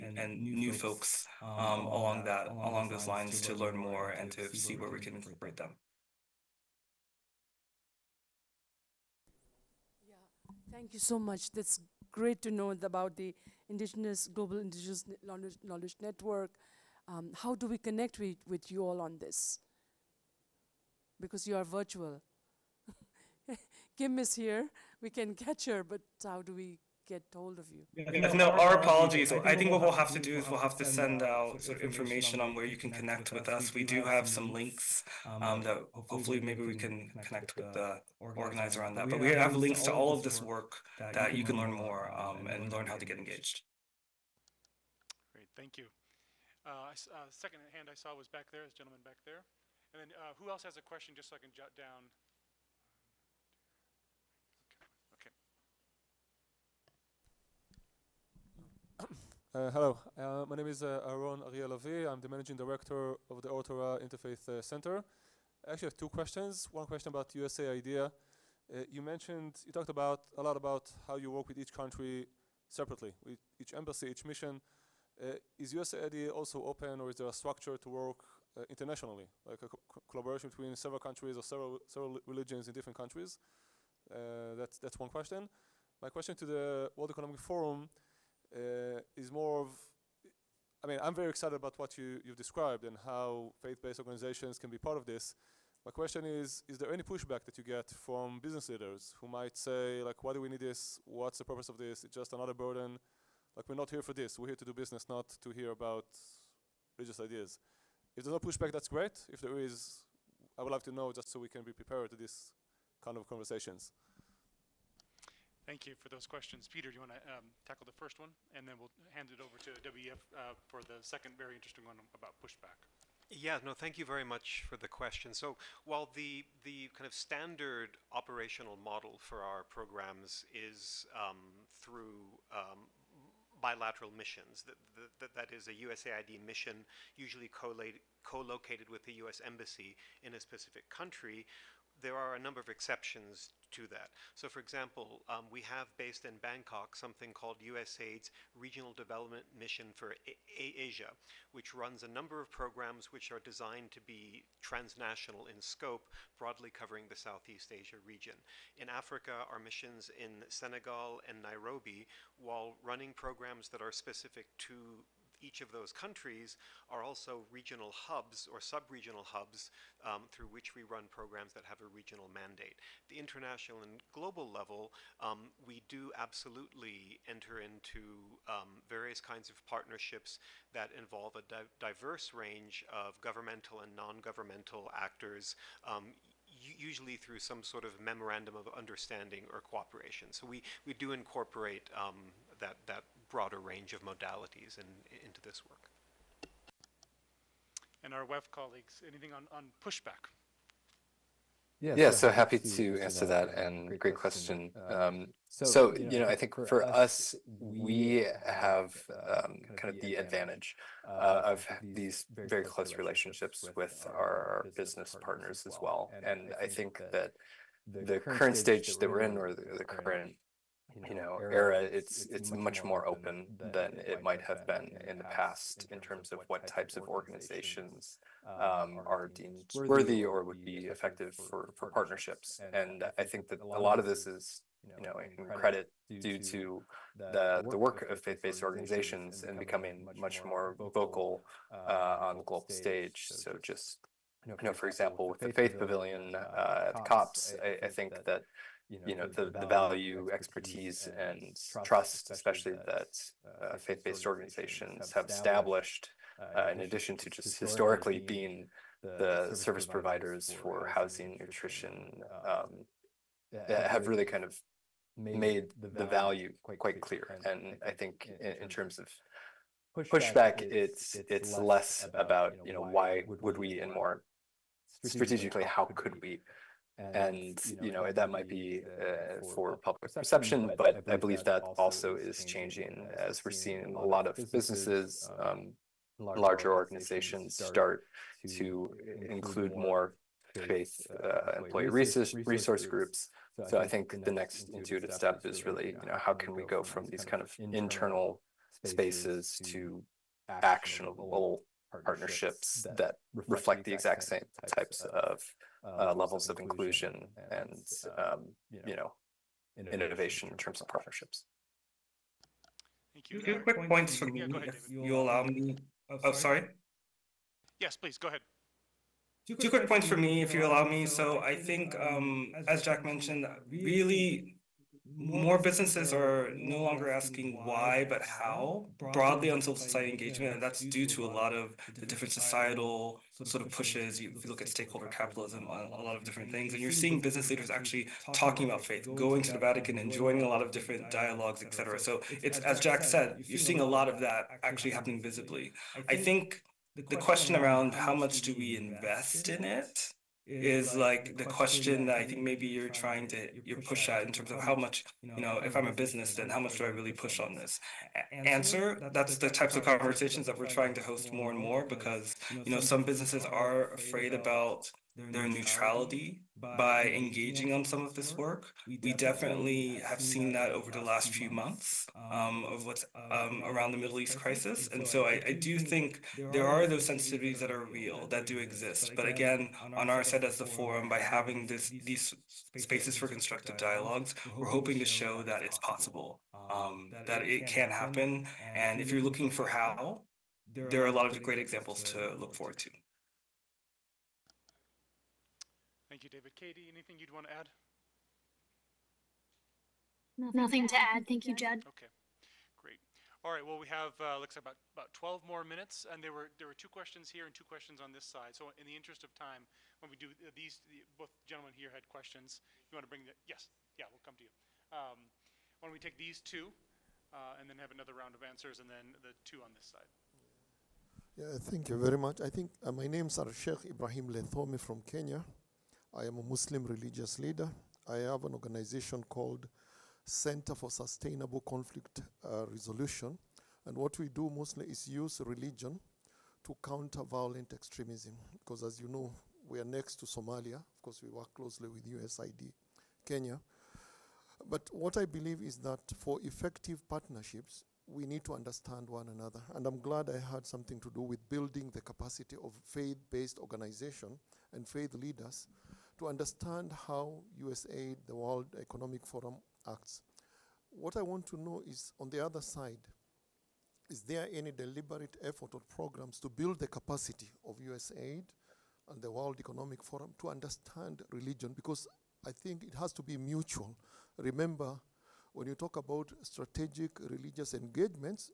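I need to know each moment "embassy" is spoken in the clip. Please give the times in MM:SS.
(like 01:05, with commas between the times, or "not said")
01:13, 02:19.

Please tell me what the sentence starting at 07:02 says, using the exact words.
I think uh, my name is Sheikh Ibrahim Lethome from Kenya.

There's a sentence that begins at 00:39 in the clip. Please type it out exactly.
But we have links to all of this work that you can learn more um, and learn how to get engaged.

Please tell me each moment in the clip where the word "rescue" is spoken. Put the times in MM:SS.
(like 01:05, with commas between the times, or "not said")
not said.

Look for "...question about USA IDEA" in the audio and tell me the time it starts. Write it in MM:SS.
01:06.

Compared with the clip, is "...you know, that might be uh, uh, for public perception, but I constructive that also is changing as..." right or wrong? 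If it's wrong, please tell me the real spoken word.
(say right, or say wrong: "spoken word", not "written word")
wrong: "believe", not "constructive".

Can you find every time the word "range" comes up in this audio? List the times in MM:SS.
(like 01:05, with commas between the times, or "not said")
03:02, 03:13.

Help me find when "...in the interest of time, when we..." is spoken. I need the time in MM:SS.
06:48.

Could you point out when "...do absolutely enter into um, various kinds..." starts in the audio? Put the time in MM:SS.
02:55.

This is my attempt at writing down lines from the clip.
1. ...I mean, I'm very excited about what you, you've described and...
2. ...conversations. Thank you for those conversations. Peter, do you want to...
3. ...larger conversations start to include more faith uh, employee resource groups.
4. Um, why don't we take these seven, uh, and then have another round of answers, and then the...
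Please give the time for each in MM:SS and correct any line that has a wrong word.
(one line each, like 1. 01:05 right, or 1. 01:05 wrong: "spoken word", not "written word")
1. 01:30 right
2. 01:53 wrong: "questions", not "conversations"
3. 04:46 wrong: "organizations", not "conversations"
4. 06:54 wrong: "two", not "seven".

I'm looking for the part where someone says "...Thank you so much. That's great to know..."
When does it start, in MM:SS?
00:10.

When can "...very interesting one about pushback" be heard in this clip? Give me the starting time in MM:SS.
02:01.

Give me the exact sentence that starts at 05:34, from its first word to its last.
You, if you look at stakeholder capitalism, a, a lot of different things.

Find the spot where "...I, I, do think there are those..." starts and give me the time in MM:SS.
06:15.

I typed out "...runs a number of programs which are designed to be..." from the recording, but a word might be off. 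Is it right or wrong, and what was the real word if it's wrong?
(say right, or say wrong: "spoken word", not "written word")
right.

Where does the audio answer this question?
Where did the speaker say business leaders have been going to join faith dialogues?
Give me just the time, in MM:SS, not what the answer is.
05:39.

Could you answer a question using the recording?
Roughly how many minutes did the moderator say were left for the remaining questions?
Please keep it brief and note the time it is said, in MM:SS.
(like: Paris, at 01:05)
12, at 06:45.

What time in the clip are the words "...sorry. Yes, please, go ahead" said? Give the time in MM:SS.
05:16.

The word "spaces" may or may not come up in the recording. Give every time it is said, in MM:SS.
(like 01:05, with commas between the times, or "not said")
04:58, 06:22.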